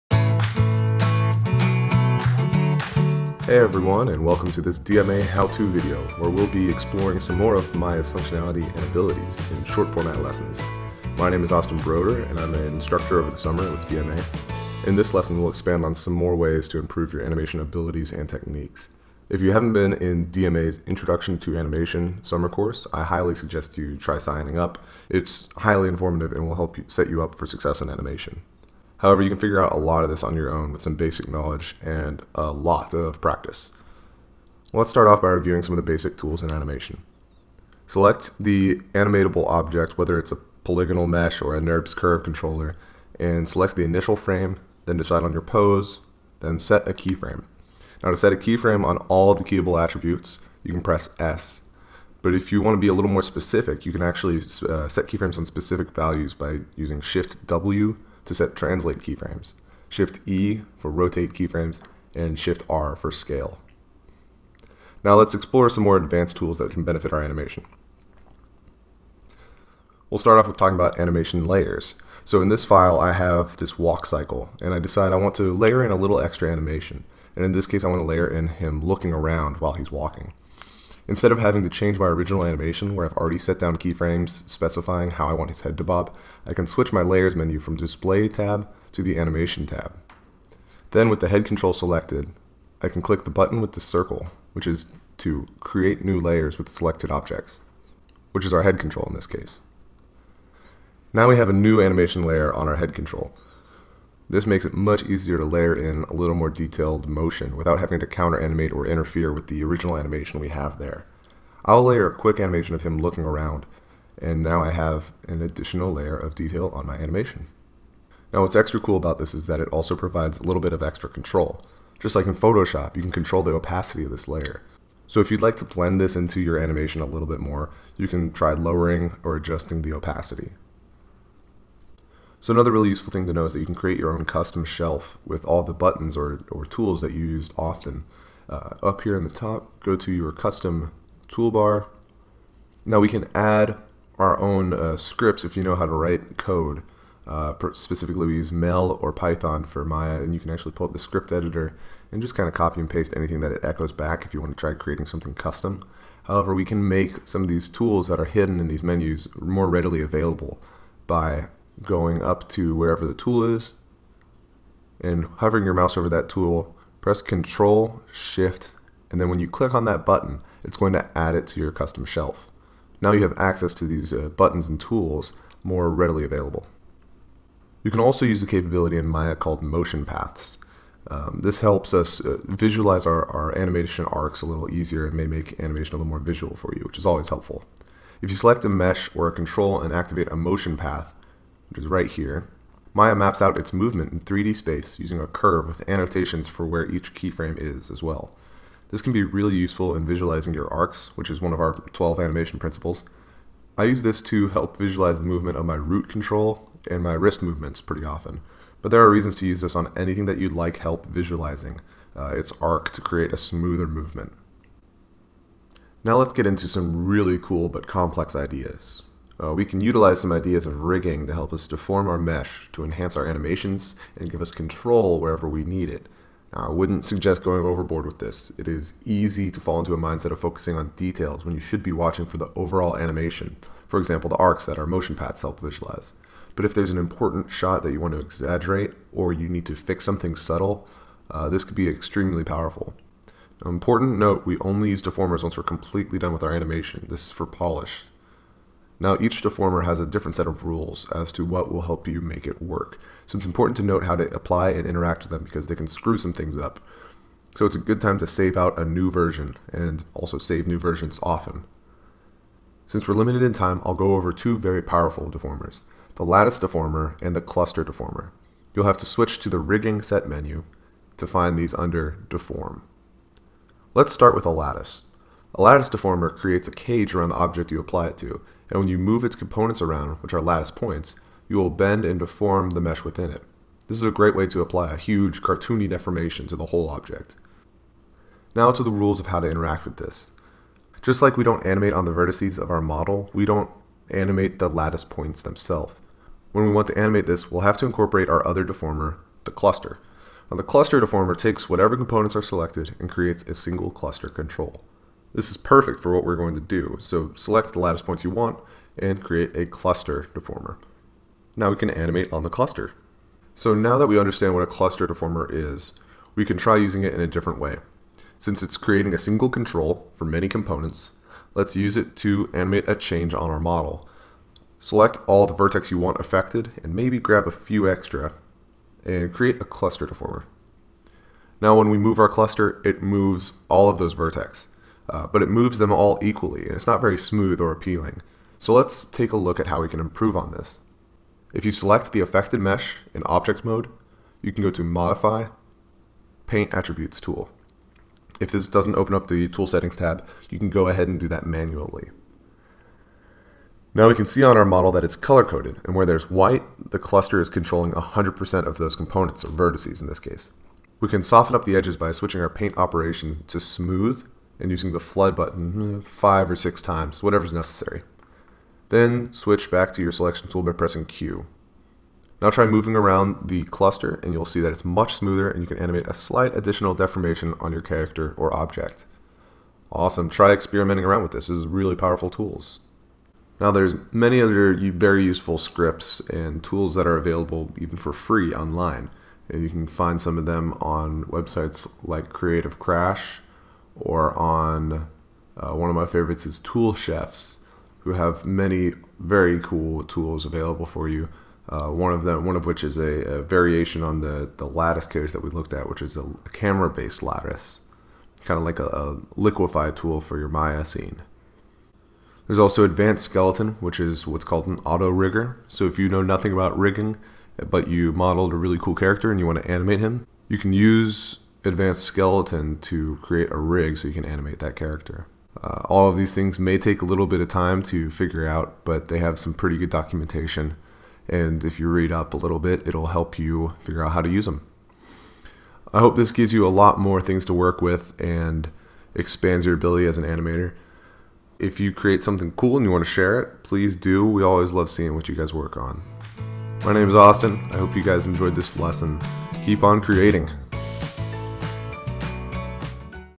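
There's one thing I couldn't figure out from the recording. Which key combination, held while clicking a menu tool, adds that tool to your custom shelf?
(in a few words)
Control Shift.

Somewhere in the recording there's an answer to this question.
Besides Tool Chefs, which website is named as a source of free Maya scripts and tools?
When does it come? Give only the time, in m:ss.
6:32.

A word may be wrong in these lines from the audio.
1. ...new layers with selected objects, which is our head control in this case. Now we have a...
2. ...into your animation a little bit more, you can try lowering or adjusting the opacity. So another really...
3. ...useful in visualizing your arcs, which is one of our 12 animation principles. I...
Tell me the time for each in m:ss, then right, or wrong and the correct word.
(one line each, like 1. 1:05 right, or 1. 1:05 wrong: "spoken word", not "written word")
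1. 1:36 right
2. 2:06 right
3. 3:19 right.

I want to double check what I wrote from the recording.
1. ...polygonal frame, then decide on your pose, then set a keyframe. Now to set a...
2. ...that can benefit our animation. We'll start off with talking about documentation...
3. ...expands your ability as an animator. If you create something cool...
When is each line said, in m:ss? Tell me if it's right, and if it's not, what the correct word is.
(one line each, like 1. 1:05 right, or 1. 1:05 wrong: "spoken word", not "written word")
1. 0:43 wrong: "initial", not "polygonal"
2. 1:06 wrong: "animation", not "documentation"
3. 7:19 right.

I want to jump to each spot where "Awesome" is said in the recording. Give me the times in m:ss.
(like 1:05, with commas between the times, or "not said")
6:19.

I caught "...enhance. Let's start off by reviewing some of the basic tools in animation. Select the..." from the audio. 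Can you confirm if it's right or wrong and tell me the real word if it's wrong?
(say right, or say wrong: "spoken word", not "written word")
wrong: "practice", not "enhance".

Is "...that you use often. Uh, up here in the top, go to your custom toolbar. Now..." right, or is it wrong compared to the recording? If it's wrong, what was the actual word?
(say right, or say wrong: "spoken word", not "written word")
right.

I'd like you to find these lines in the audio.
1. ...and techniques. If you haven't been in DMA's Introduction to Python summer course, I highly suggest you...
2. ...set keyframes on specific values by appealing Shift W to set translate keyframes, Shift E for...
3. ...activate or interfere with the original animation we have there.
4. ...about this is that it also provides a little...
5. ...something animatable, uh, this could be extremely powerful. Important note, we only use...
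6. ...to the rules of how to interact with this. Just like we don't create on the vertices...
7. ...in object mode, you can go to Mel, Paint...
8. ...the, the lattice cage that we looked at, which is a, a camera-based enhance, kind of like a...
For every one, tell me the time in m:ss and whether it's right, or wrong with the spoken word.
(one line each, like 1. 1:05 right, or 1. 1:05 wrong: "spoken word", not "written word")
1. 0:18 wrong: "Animation", not "Python"
2. 0:54 wrong: "using", not "appealing"
3. 1:48 wrong: "animate", not "activate"
4. 1:58 right
5. 4:00 wrong: "subtle", not "animatable"
6. 4:48 wrong: "animate", not "create"
7. 5:43 wrong: "Modify", not "Mel"
8. 6:44 wrong: "lattice", not "enhance".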